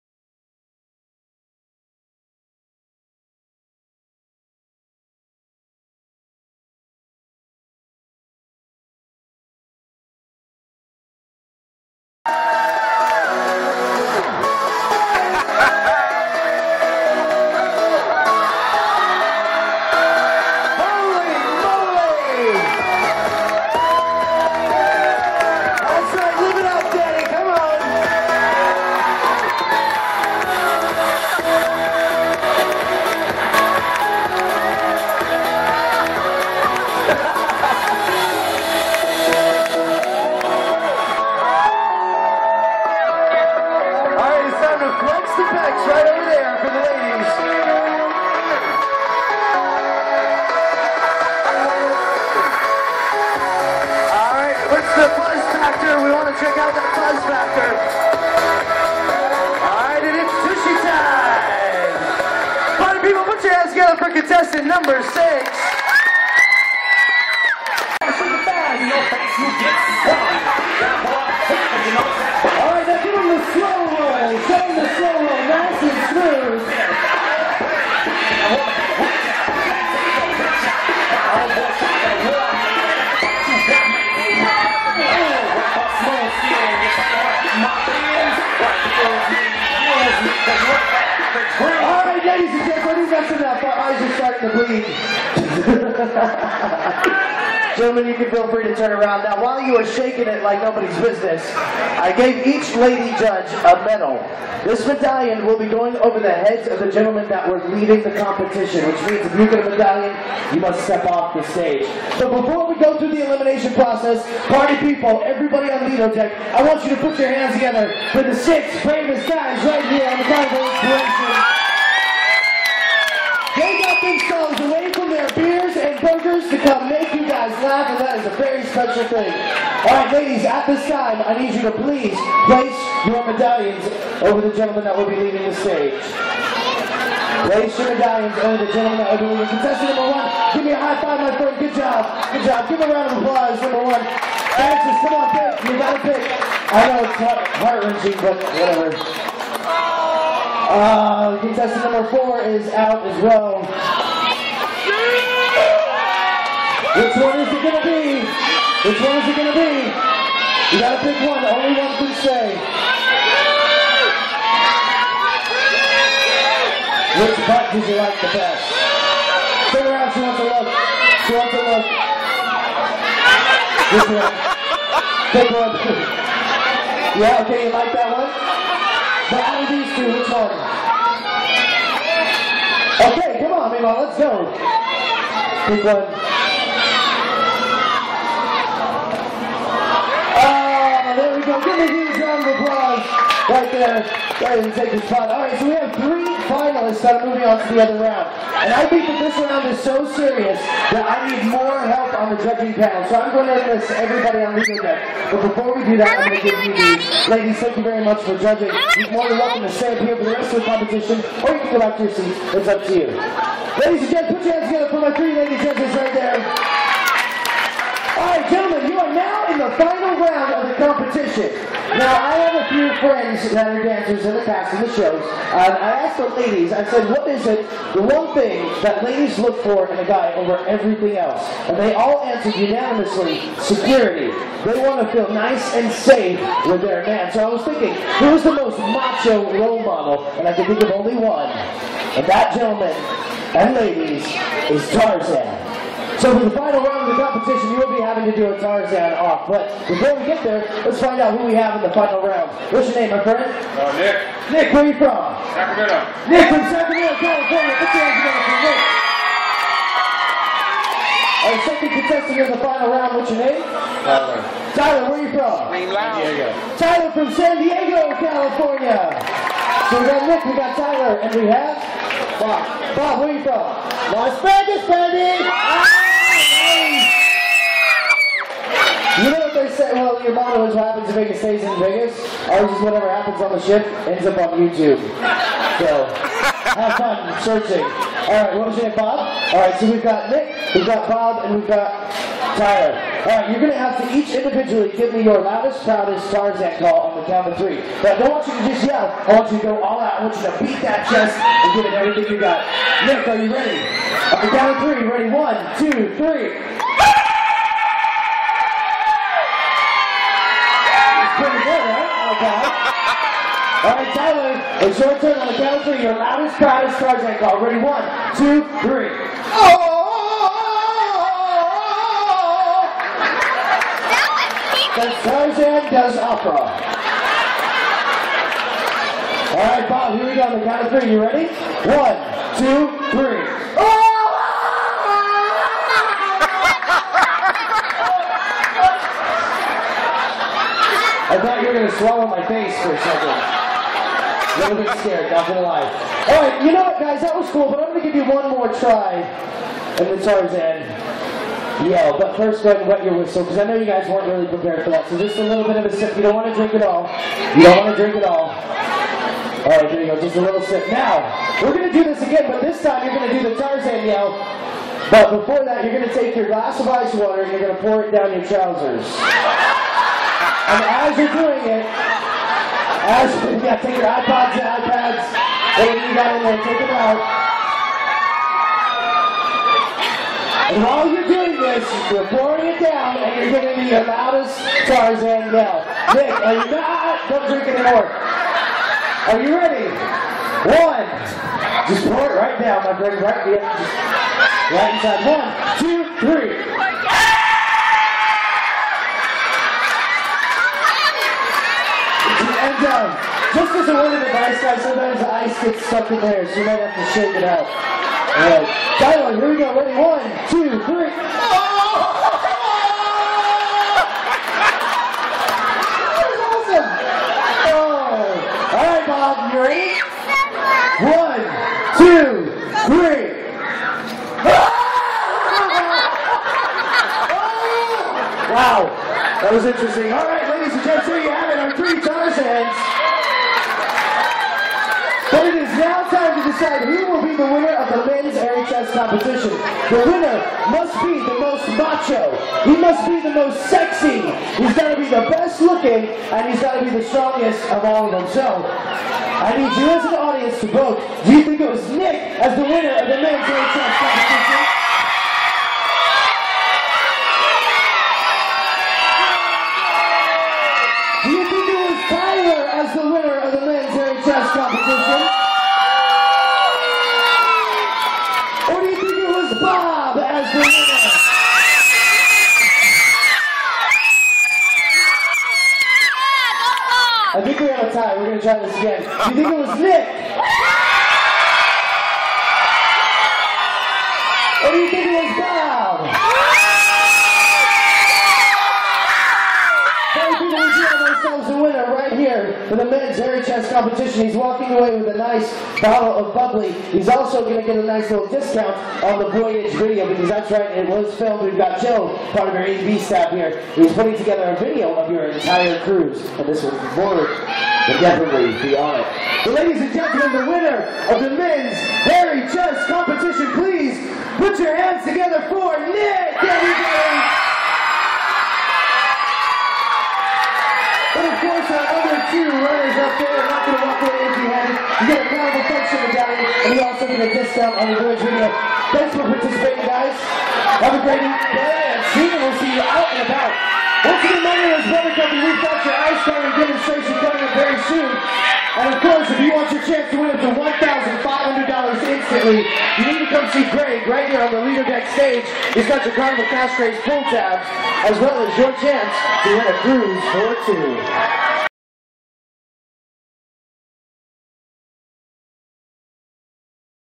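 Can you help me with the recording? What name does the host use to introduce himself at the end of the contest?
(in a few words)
Brother Guppy.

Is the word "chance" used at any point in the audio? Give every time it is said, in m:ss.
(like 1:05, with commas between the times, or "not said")
8:59, 9:08.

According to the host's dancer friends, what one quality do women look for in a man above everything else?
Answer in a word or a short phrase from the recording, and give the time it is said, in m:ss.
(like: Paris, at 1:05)
Security, at 3:53.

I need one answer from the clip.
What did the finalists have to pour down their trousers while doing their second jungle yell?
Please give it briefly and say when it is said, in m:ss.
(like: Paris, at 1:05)
Ice water, at 6:06.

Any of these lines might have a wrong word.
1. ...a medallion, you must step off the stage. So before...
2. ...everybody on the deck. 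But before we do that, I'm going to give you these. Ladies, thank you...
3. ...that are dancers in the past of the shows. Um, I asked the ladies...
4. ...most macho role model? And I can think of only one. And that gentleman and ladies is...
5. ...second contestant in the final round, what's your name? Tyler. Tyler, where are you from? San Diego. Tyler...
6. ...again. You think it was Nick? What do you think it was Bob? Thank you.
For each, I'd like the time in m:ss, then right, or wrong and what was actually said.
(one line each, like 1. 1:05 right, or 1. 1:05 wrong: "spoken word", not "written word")
1. 1:49 right
2. 3:23 right
3. 3:43 right
4. 3:58 right
5. 4:21 right
6. 7:58 right.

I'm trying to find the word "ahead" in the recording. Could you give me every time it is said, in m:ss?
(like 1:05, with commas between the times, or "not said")
3:14, 5:52.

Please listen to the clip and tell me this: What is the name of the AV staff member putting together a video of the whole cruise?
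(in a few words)
Joe.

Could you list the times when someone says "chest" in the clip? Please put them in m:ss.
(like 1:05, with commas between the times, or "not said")
5:01, 7:18, 7:33, 8:32.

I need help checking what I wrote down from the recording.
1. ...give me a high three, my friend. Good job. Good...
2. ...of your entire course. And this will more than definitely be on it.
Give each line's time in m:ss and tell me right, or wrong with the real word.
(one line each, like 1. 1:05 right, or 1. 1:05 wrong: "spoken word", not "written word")
1. 2:20 wrong: "five", not "three"
2. 8:24 wrong: "cruise", not "course".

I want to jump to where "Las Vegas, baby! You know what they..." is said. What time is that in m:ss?
4:34.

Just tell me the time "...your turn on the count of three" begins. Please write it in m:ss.
5:14.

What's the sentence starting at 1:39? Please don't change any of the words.
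Now, while you are shaking it like nobody's business, I gave each lady judge a medal.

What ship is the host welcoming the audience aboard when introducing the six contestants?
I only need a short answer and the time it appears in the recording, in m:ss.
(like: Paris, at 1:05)
Carnival Inspiration, at 2:00.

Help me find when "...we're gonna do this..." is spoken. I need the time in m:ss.
6:01.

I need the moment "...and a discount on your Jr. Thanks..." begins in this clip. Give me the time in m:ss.
8:47.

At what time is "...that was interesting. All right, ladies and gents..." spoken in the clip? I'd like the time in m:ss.
7:09.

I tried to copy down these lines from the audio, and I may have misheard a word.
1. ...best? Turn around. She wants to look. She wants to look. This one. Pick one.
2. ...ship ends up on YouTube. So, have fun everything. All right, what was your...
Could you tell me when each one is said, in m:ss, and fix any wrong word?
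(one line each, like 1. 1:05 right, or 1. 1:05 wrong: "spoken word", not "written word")
1. 2:48 right
2. 4:43 wrong: "searching", not "everything".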